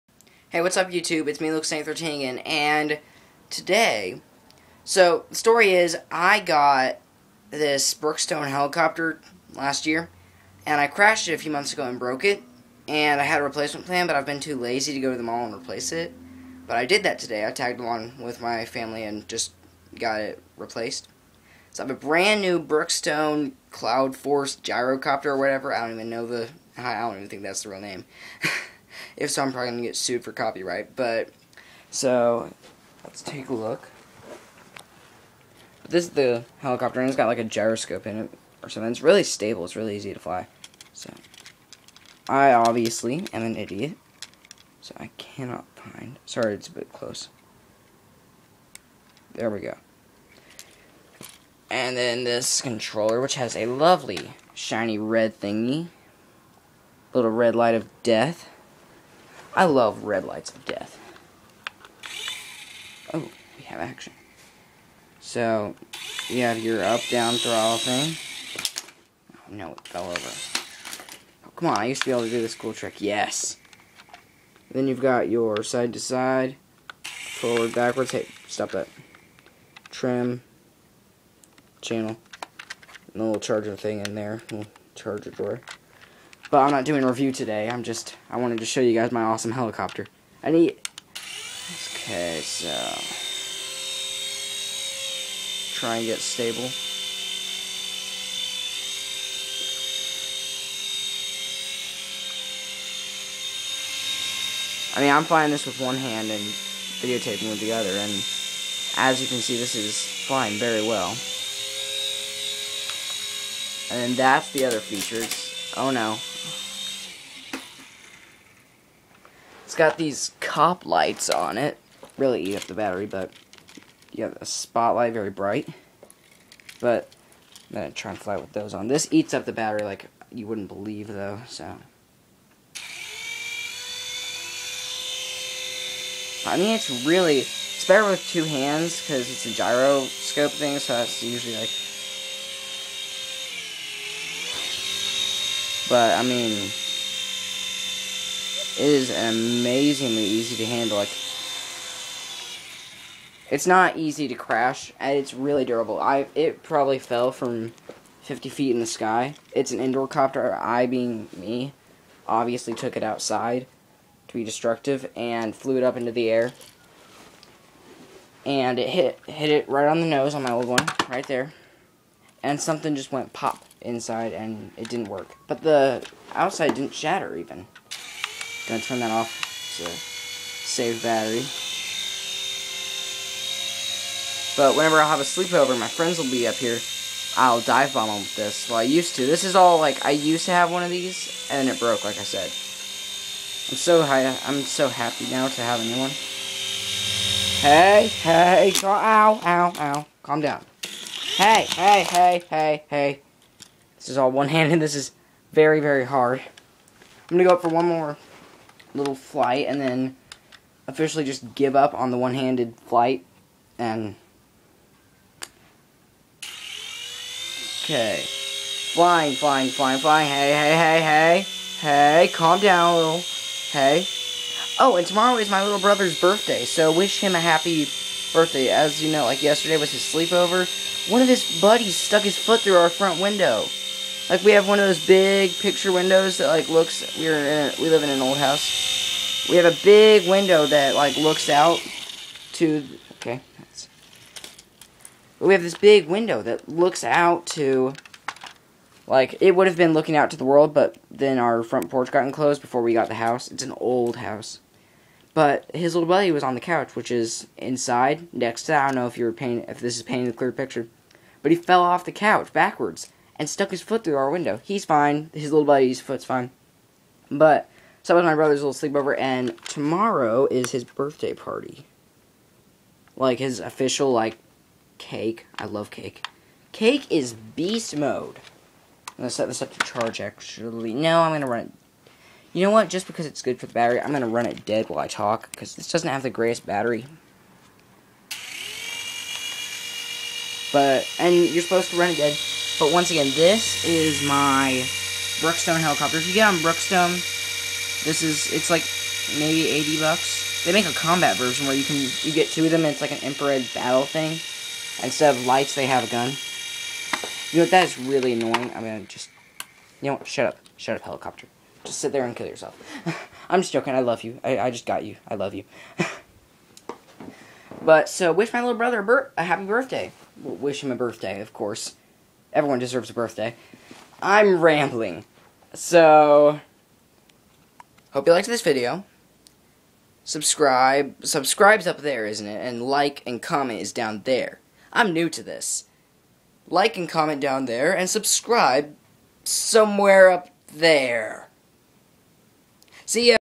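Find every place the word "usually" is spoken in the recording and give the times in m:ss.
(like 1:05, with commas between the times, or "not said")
2:21.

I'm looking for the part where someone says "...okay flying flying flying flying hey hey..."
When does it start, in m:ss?
3:37.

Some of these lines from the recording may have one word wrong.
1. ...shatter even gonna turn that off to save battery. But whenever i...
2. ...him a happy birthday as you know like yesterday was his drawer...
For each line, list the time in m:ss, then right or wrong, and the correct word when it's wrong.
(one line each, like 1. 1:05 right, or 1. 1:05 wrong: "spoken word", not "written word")
1. 2:56 right
2. 3:47 wrong: "sleepover", not "drawer".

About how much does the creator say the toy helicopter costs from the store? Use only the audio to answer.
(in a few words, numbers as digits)
$80.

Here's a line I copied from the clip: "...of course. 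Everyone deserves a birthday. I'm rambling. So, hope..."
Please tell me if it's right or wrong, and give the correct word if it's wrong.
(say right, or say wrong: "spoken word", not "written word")
right.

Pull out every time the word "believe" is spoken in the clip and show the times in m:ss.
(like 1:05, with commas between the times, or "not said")
2:10.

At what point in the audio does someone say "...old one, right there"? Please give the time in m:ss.
2:50.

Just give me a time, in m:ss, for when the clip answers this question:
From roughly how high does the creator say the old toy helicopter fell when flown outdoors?
2:38.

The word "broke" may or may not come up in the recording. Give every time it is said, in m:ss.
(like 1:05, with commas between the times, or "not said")
0:11, 3:11.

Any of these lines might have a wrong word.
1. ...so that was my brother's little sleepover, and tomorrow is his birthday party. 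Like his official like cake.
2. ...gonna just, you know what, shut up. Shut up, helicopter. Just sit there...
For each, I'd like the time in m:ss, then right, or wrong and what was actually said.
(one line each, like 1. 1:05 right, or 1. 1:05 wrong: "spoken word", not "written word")
1. 4:28 right
2. 5:08 right.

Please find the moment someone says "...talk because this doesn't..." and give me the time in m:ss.
4:45.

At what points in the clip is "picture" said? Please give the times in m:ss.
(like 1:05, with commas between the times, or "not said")
3:55, 4:20.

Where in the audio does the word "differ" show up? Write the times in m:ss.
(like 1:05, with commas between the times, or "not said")
not said.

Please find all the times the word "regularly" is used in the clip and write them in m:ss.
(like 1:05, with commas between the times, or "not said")
not said.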